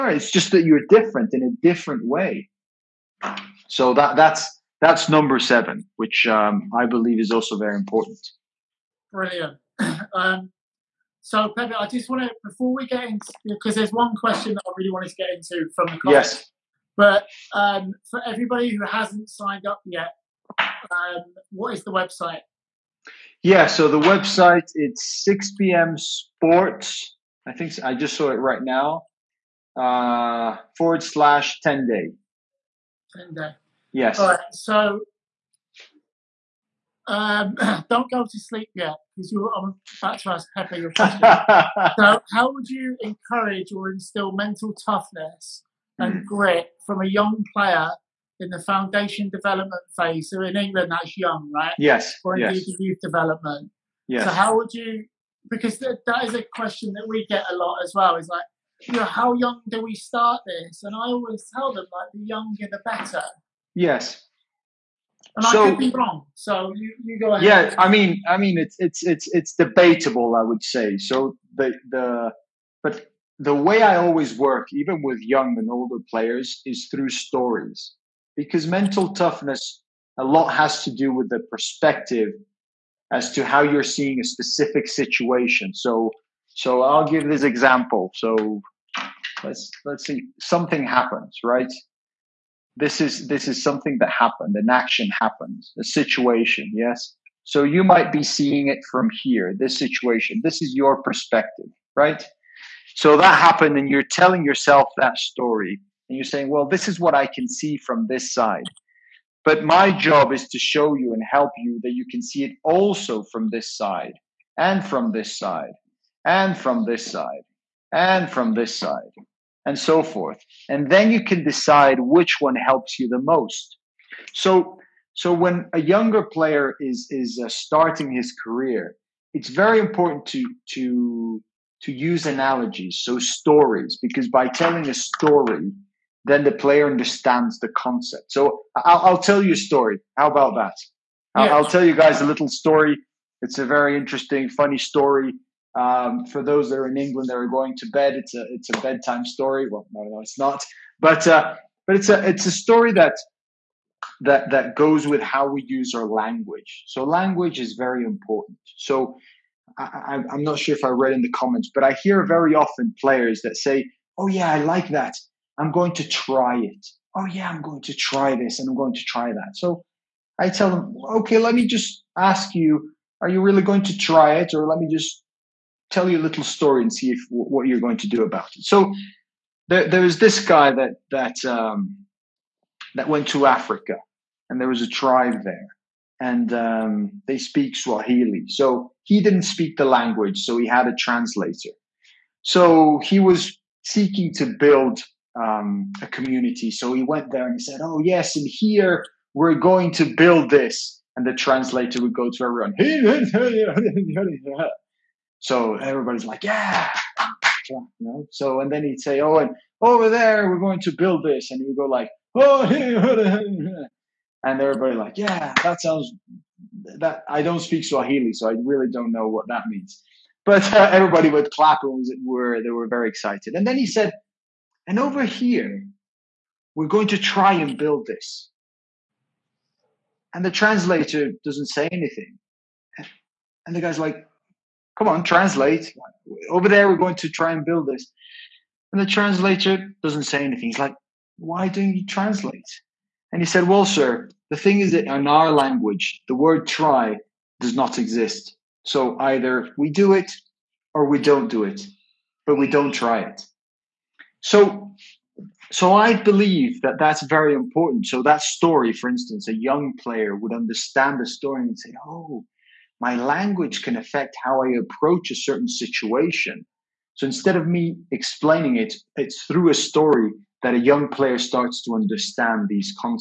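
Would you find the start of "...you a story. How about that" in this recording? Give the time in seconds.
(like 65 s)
139 s.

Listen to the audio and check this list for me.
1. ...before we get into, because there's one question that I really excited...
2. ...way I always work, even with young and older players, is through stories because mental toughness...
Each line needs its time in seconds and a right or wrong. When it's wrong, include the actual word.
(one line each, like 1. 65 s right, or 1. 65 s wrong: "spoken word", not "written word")
1. 12 s wrong: "wanted", not "excited"
2. 73 s right.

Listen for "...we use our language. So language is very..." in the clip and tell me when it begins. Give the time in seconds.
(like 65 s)
155 s.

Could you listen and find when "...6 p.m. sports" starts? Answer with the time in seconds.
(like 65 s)
25 s.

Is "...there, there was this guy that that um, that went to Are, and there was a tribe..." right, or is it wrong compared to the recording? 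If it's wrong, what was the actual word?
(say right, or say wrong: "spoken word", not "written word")
wrong: "Africa", not "Are".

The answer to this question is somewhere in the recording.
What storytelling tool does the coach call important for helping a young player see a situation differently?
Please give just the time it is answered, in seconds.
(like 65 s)
132 s.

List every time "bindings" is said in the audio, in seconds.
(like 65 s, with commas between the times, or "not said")
not said.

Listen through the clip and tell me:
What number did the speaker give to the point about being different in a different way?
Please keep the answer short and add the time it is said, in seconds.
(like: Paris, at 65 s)
7, at 5 s.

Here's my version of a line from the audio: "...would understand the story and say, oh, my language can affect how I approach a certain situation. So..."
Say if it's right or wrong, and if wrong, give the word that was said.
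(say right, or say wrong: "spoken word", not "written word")
right.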